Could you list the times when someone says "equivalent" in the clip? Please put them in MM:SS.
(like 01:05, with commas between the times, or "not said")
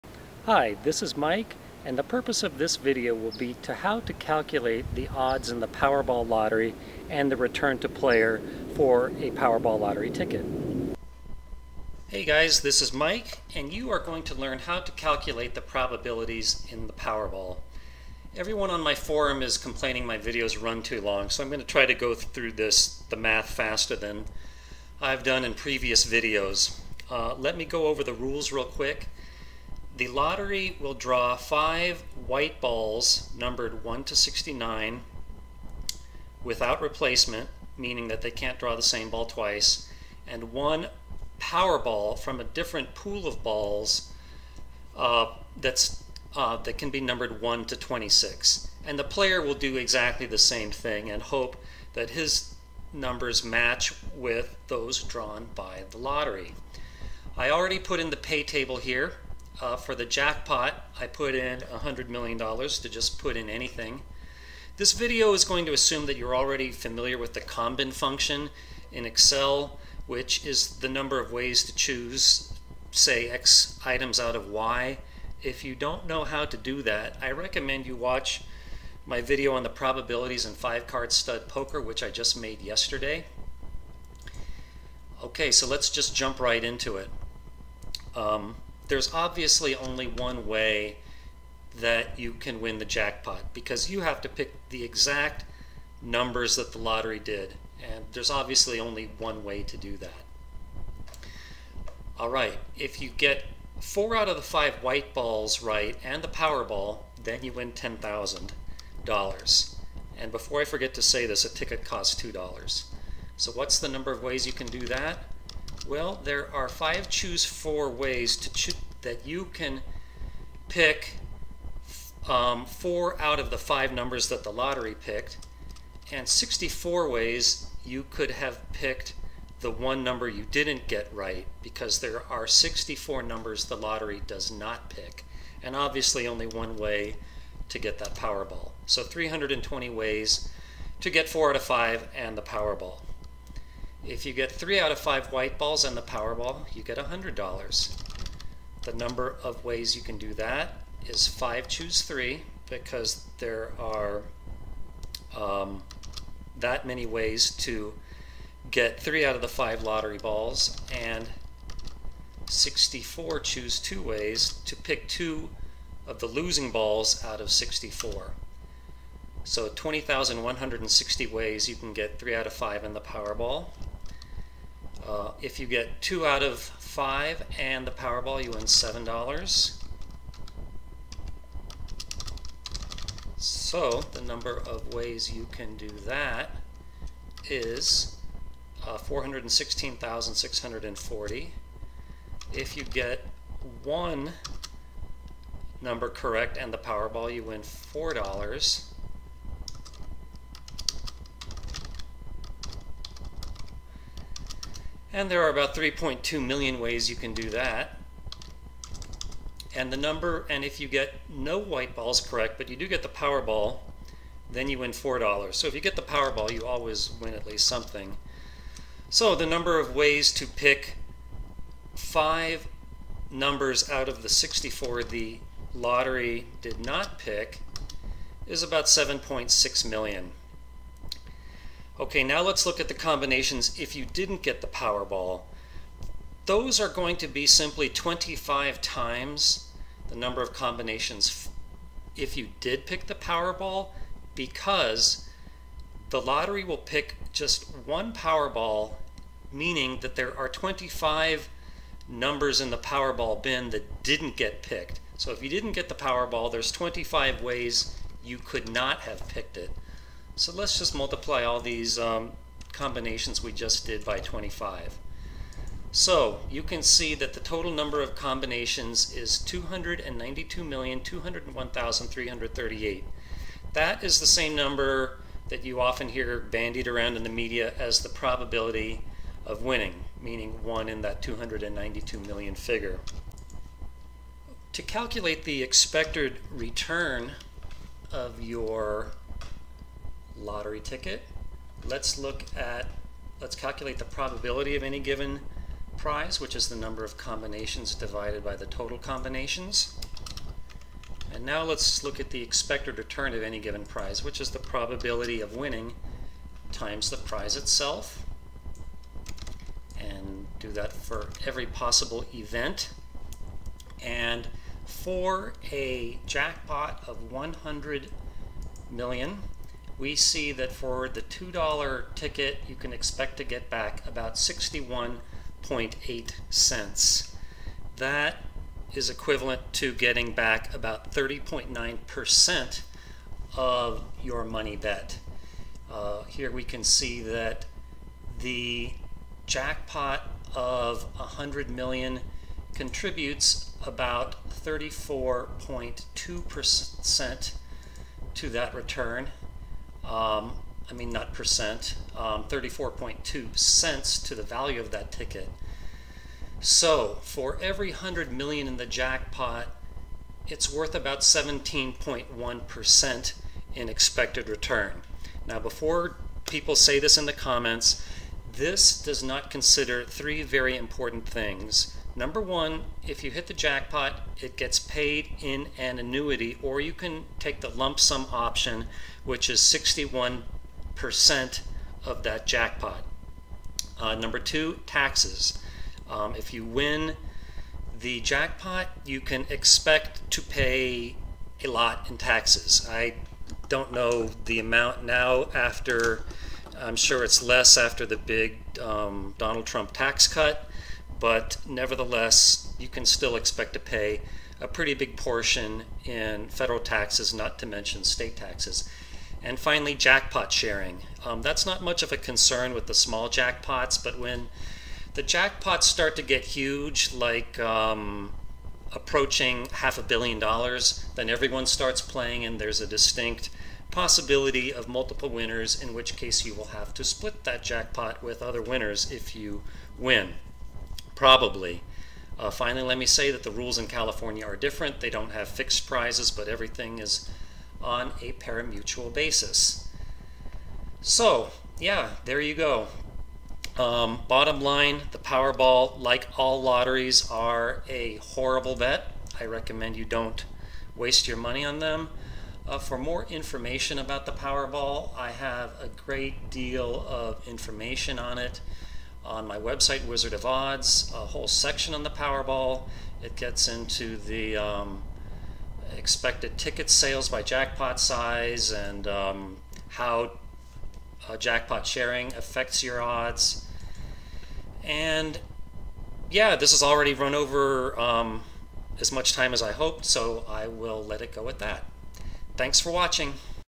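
05:29.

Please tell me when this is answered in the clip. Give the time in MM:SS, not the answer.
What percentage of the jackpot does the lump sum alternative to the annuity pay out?
06:19.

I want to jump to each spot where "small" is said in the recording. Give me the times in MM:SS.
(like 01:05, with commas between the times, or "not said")
06:52.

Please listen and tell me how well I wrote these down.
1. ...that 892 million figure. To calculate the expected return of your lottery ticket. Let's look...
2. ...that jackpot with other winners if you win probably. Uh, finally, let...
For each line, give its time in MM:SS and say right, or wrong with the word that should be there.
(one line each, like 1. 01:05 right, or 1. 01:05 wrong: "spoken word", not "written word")
1. 04:41 wrong: "292", not "892"
2. 07:07 right.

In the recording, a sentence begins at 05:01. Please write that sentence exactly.
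And now let's look at the expected return of any given prize, which is the probability of winning times the prize itself.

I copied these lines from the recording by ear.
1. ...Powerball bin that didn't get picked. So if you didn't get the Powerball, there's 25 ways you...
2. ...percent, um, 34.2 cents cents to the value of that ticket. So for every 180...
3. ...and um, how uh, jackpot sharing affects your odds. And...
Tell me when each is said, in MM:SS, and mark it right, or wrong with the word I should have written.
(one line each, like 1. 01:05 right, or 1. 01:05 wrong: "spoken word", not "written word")
1. 04:12 right
2. 05:51 wrong: "100", not "180"
3. 07:48 right.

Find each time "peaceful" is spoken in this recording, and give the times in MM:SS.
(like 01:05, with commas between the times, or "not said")
not said.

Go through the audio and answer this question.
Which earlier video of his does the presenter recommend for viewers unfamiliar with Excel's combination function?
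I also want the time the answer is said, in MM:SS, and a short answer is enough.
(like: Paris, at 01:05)
five-card stud poker, at 01:20.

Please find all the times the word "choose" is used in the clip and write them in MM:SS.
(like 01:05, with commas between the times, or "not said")
01:11, 01:57, 02:31, 02:43.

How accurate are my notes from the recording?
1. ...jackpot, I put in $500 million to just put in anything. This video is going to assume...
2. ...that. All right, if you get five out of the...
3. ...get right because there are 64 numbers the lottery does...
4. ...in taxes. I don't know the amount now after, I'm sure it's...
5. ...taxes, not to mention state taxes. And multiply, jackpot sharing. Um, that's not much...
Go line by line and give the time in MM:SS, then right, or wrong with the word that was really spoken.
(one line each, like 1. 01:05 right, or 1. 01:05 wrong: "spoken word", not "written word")
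1. 01:00 wrong: "100", not "500"
2. 01:39 wrong: "four", not "five"
3. 02:10 right
4. 06:32 right
5. 06:46 wrong: "finally", not "multiply".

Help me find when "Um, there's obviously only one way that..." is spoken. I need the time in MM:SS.
01:28.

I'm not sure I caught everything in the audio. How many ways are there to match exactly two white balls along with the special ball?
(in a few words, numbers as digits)
416,640.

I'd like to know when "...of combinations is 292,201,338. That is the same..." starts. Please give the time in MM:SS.
04:28.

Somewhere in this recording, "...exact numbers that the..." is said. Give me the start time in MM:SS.
01:34.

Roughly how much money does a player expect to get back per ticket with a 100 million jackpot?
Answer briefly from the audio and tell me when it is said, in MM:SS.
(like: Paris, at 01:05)
61.8 cents, at 05:24.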